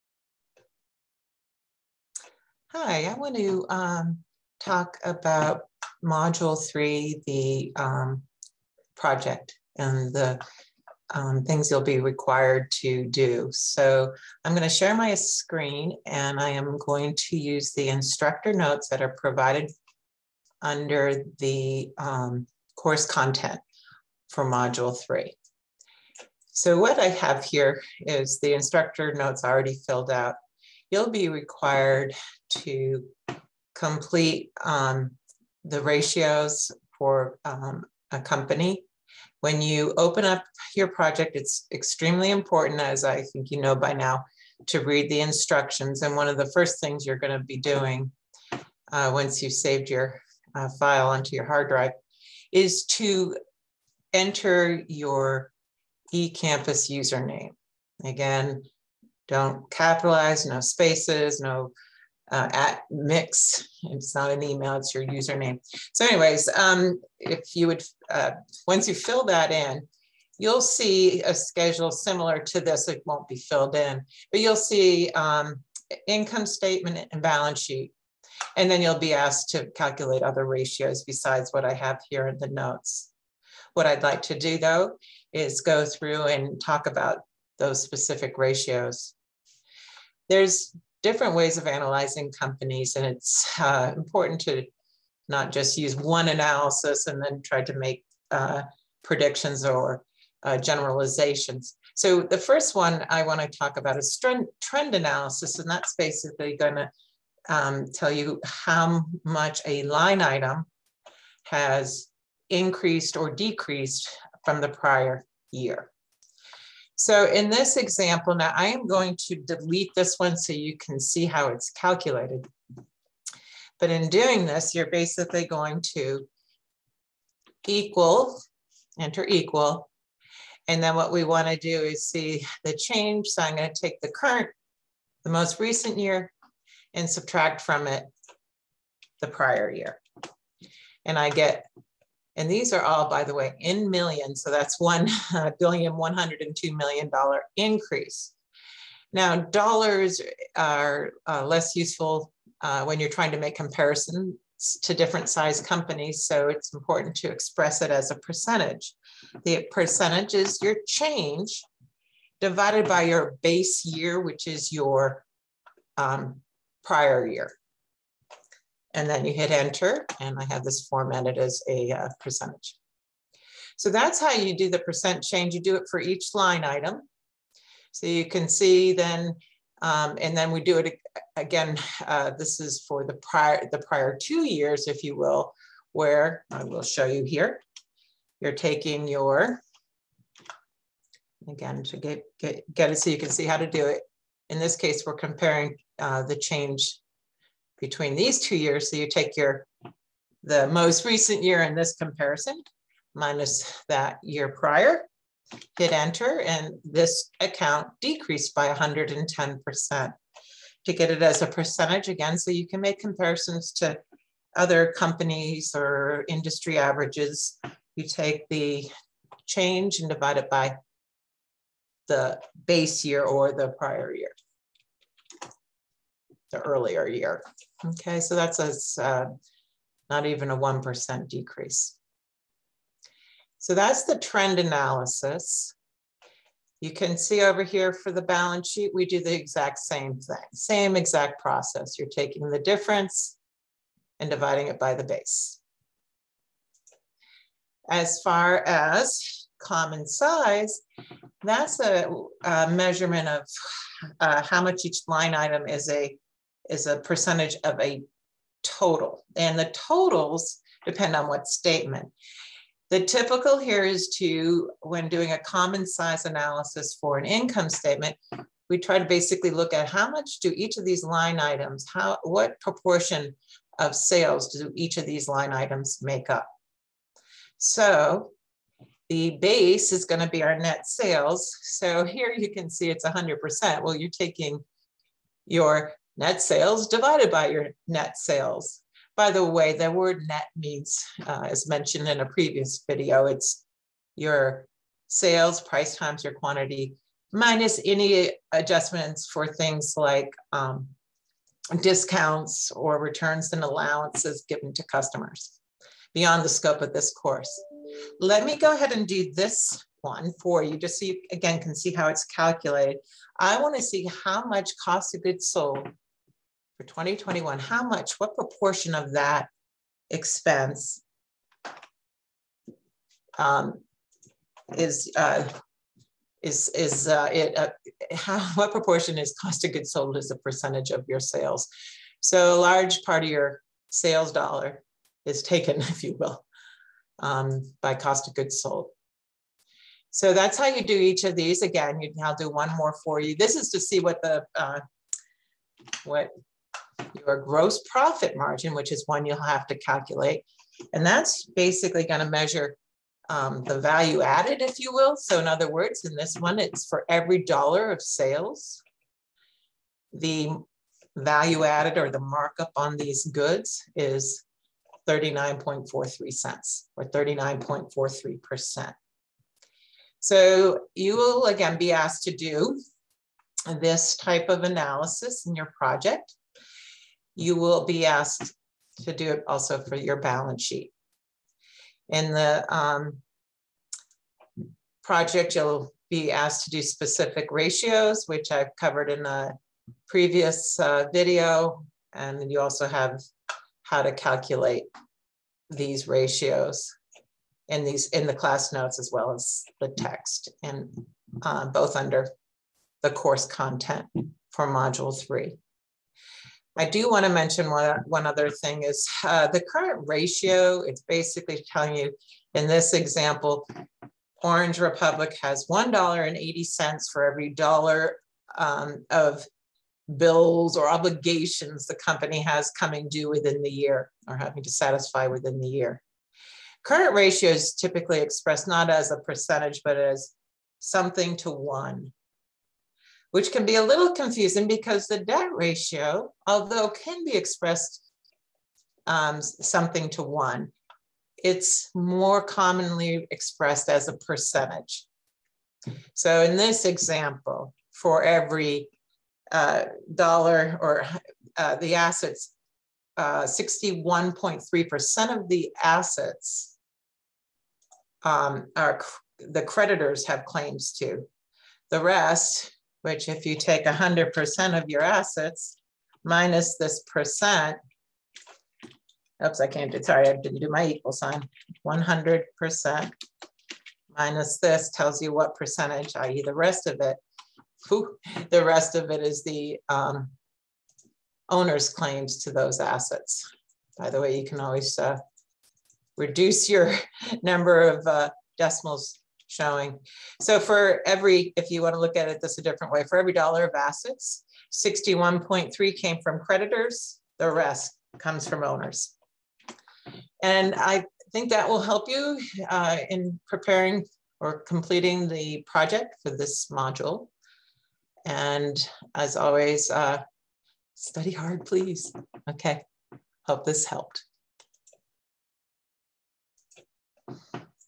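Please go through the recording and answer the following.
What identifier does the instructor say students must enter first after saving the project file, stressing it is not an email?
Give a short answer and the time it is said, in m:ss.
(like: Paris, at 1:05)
eCampus username, at 0:56.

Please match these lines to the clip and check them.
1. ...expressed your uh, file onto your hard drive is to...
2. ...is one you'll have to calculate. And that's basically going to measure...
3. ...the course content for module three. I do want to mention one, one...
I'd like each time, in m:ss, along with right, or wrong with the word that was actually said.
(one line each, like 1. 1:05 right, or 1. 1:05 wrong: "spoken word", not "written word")
1. 0:49 wrong: "saved", not "expressed"
2. 5:48 right
3. 6:43 right.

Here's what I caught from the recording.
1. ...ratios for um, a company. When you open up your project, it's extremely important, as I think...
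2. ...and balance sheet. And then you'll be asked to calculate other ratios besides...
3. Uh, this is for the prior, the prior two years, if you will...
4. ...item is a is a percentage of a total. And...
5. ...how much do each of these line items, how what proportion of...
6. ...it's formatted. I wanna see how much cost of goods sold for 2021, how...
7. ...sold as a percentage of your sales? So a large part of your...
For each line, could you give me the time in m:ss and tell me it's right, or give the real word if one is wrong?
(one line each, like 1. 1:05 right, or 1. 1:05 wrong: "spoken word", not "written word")
1. 0:35 right
2. 1:17 right
3. 3:02 right
4. 4:15 right
5. 4:29 right
6. 5:12 wrong: "calculated", not "formatted"
7. 5:29 right.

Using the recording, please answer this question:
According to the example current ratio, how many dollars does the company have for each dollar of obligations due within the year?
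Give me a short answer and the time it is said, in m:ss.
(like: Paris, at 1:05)
$1.80, at 6:55.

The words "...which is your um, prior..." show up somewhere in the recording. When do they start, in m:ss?
2:44.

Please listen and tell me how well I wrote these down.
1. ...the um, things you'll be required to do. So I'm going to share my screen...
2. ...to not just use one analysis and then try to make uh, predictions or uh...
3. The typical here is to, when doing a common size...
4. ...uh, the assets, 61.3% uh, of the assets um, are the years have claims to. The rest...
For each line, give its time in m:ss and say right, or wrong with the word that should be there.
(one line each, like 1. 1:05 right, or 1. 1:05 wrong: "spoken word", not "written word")
1. 0:10 right
2. 1:34 right
3. 4:22 right
4. 7:31 wrong: "creditors", not "years".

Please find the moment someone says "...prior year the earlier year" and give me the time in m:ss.
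3:43.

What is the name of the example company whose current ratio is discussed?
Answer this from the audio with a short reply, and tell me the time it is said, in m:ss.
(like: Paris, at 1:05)
Orange Republic, at 6:54.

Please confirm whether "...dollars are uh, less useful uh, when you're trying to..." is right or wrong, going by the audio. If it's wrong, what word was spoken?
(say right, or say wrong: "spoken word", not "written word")
right.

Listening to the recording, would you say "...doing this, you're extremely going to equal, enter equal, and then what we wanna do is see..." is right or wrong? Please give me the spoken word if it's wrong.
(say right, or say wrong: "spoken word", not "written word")
wrong: "basically", not "extremely".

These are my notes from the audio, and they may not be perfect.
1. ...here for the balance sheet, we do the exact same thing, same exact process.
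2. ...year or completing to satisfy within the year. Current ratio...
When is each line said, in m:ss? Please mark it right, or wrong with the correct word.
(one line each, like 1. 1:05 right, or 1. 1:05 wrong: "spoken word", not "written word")
1. 3:57 right
2. 7:03 wrong: "having", not "completing".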